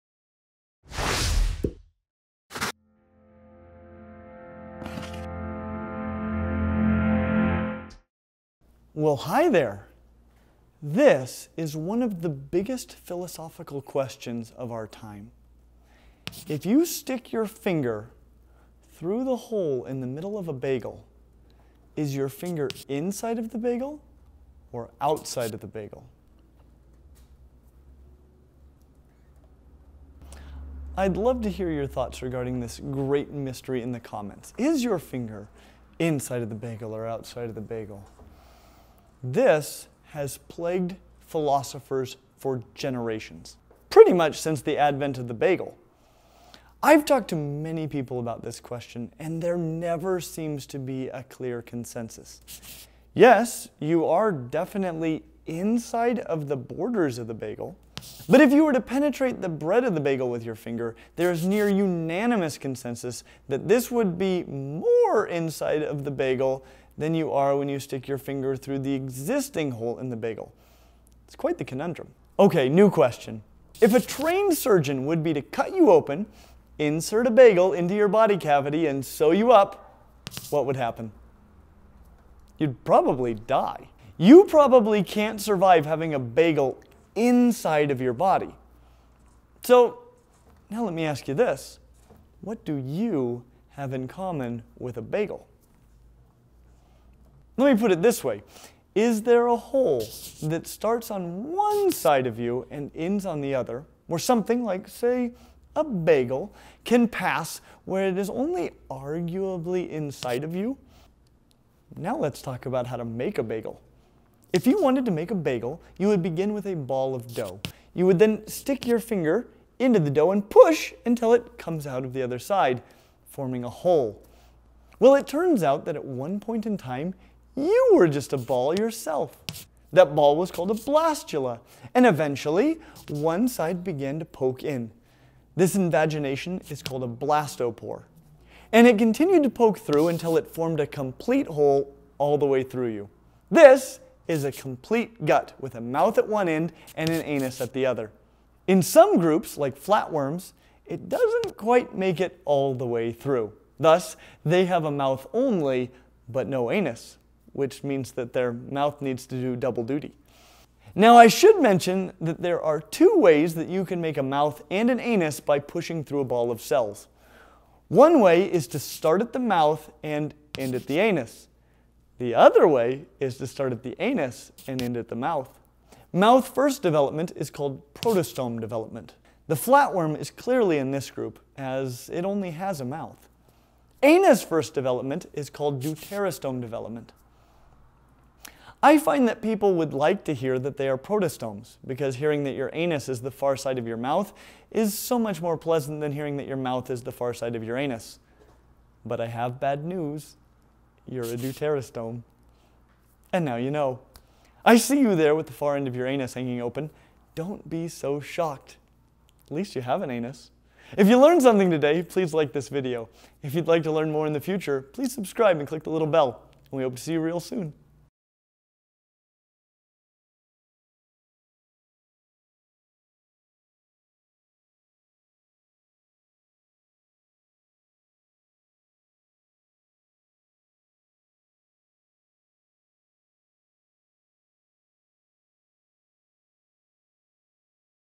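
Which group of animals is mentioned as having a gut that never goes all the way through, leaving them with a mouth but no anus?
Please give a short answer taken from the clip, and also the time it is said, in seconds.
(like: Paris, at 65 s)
flatworms, at 149 s.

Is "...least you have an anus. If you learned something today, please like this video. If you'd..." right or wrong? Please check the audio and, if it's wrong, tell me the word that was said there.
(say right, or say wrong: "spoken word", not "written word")
right.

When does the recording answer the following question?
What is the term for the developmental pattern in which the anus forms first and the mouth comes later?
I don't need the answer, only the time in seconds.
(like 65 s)
185 s.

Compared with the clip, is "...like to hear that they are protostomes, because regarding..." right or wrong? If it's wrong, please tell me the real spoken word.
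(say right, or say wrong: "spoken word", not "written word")
wrong: "hearing", not "regarding".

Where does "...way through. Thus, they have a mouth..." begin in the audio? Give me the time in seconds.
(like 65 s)
152 s.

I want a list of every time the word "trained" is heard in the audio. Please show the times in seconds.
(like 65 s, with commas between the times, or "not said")
73 s.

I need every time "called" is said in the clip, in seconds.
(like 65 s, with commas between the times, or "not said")
130 s, 136 s, 177 s, 185 s.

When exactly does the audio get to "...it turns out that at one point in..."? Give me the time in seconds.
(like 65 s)
125 s.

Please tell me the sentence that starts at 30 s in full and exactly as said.
I'd love to hear your thoughts regarding this great mystery in the comments.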